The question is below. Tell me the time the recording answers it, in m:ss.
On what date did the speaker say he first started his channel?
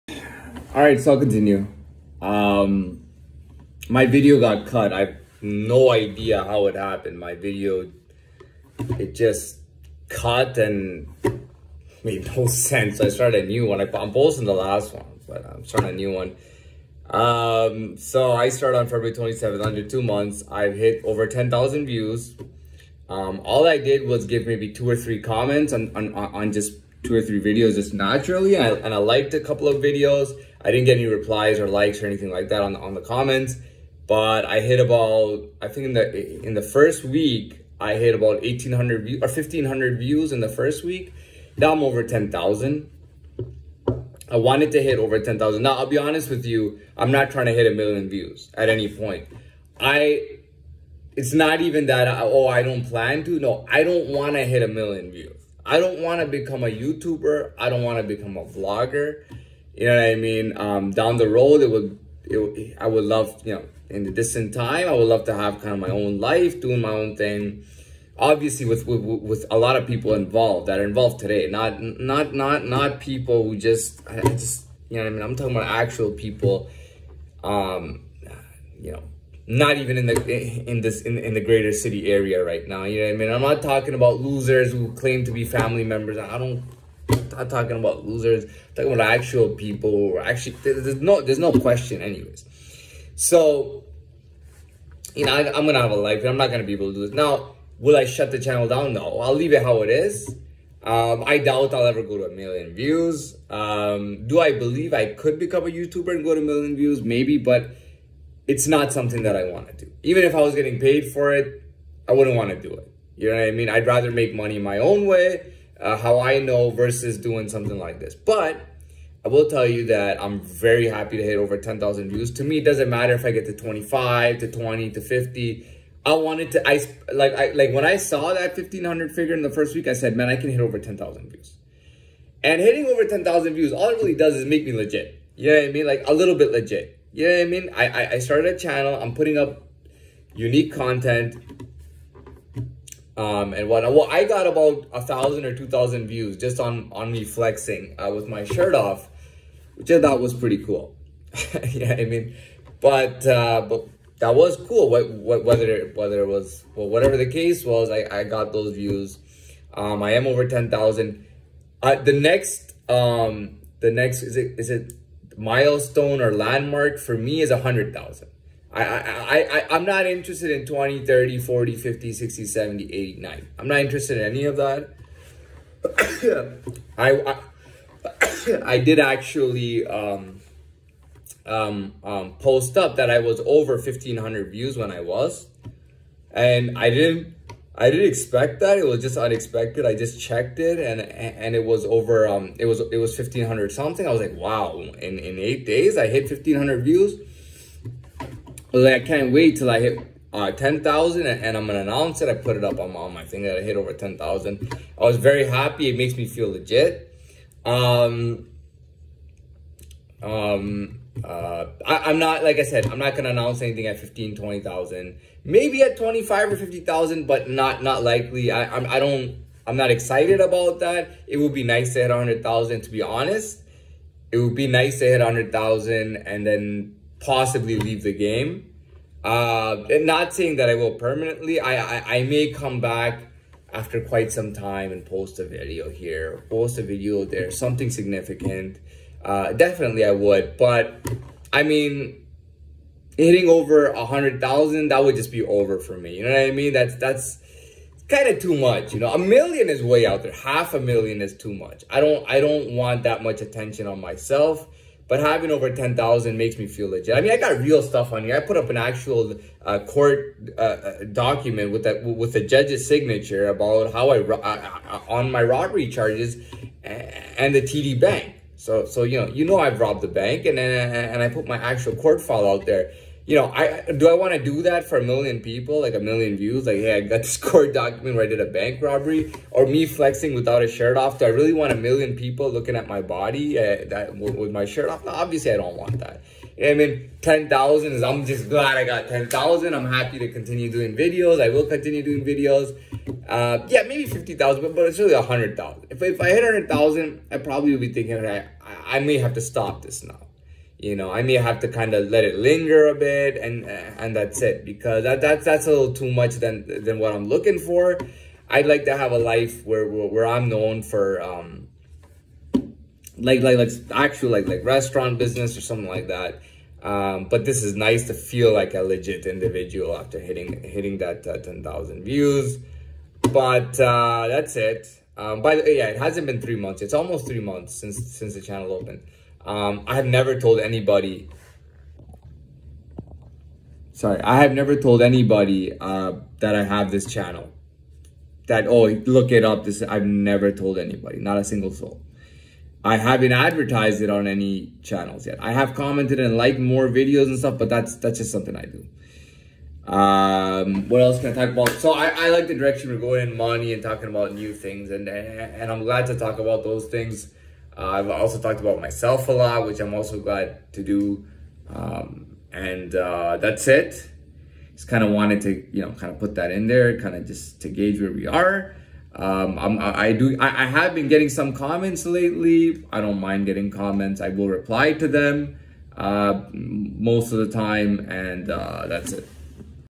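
0:18.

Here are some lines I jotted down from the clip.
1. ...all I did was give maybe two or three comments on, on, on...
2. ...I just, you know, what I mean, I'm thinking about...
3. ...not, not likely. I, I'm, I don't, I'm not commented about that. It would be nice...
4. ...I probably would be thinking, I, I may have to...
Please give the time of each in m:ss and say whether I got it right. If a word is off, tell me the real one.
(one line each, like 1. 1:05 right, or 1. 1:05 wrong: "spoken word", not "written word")
1. 0:23 right
2. 1:14 wrong: "talking", not "thinking"
3. 3:37 wrong: "excited", not "commented"
4. 4:57 right.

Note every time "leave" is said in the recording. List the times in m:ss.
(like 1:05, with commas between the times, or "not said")
1:39, 3:47.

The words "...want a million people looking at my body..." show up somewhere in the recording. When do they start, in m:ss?
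4:41.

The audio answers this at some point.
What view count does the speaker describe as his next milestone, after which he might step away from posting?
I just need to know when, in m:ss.
2:47.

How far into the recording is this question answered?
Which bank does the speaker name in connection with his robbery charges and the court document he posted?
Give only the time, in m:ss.
4:27.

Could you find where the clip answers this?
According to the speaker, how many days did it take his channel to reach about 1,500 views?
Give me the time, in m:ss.
3:15.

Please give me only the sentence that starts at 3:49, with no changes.
Uh, not saying that I will permanently.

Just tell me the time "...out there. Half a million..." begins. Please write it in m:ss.
4:10.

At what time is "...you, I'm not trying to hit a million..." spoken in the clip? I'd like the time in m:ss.
0:46.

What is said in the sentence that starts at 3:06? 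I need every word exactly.
And I didn't I didn't expect that.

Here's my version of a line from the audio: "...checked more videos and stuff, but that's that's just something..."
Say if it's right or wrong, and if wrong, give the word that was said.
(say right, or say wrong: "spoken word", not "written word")
wrong: "liked", not "checked".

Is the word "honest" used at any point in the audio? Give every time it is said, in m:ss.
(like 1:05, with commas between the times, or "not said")
0:45, 3:43.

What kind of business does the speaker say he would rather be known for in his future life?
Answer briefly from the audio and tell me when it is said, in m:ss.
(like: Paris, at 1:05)
restaurant business, at 5:14.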